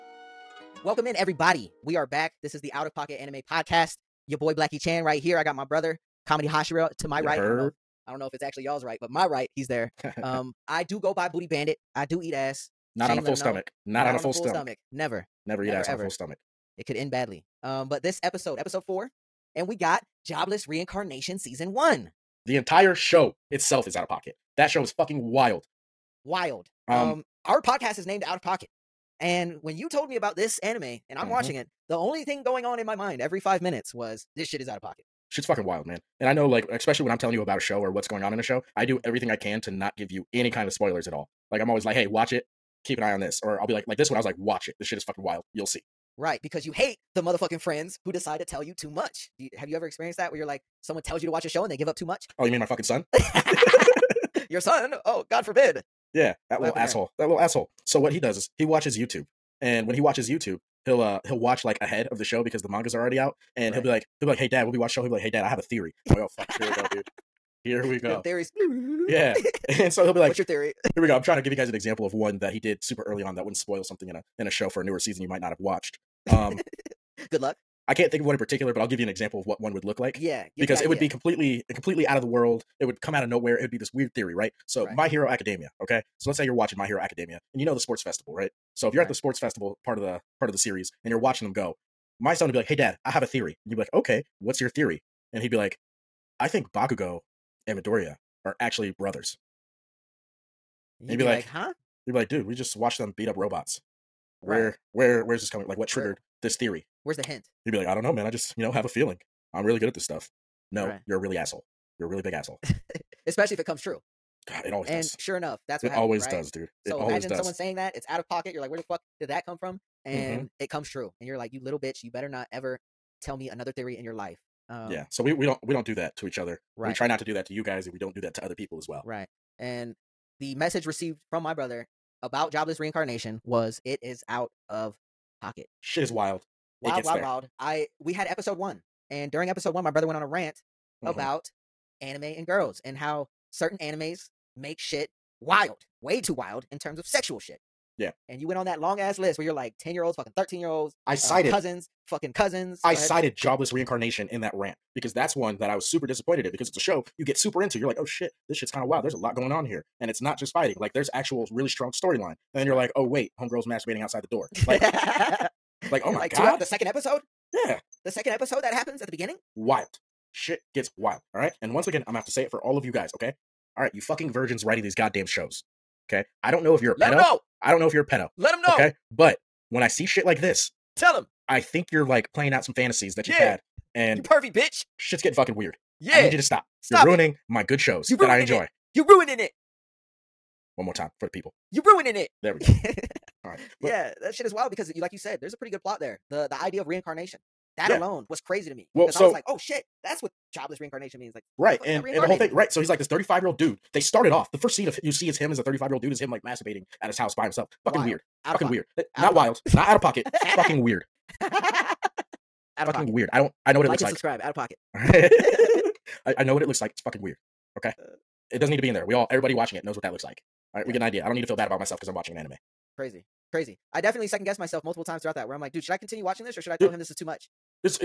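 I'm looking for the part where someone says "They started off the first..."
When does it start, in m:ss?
3:23.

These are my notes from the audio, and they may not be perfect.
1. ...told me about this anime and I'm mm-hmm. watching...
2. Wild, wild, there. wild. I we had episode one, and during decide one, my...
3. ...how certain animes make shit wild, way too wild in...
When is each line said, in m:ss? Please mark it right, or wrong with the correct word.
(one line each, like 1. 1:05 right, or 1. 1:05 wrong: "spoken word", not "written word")
1. 0:29 right
2. 2:16 wrong: "episode", not "decide"
3. 2:22 right.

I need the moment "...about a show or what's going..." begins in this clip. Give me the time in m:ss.
0:37.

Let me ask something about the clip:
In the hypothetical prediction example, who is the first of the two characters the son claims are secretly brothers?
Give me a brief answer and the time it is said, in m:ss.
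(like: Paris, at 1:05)
Bakugo, at 1:36.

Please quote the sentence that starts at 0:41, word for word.
Like, I'm always like, hey, watch it, keep an eye on this.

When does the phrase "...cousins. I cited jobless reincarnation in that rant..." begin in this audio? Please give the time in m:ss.
2:32.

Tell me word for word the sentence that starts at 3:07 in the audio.
my good shows that I enjoy.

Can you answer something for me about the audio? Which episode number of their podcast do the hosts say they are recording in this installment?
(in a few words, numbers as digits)
4.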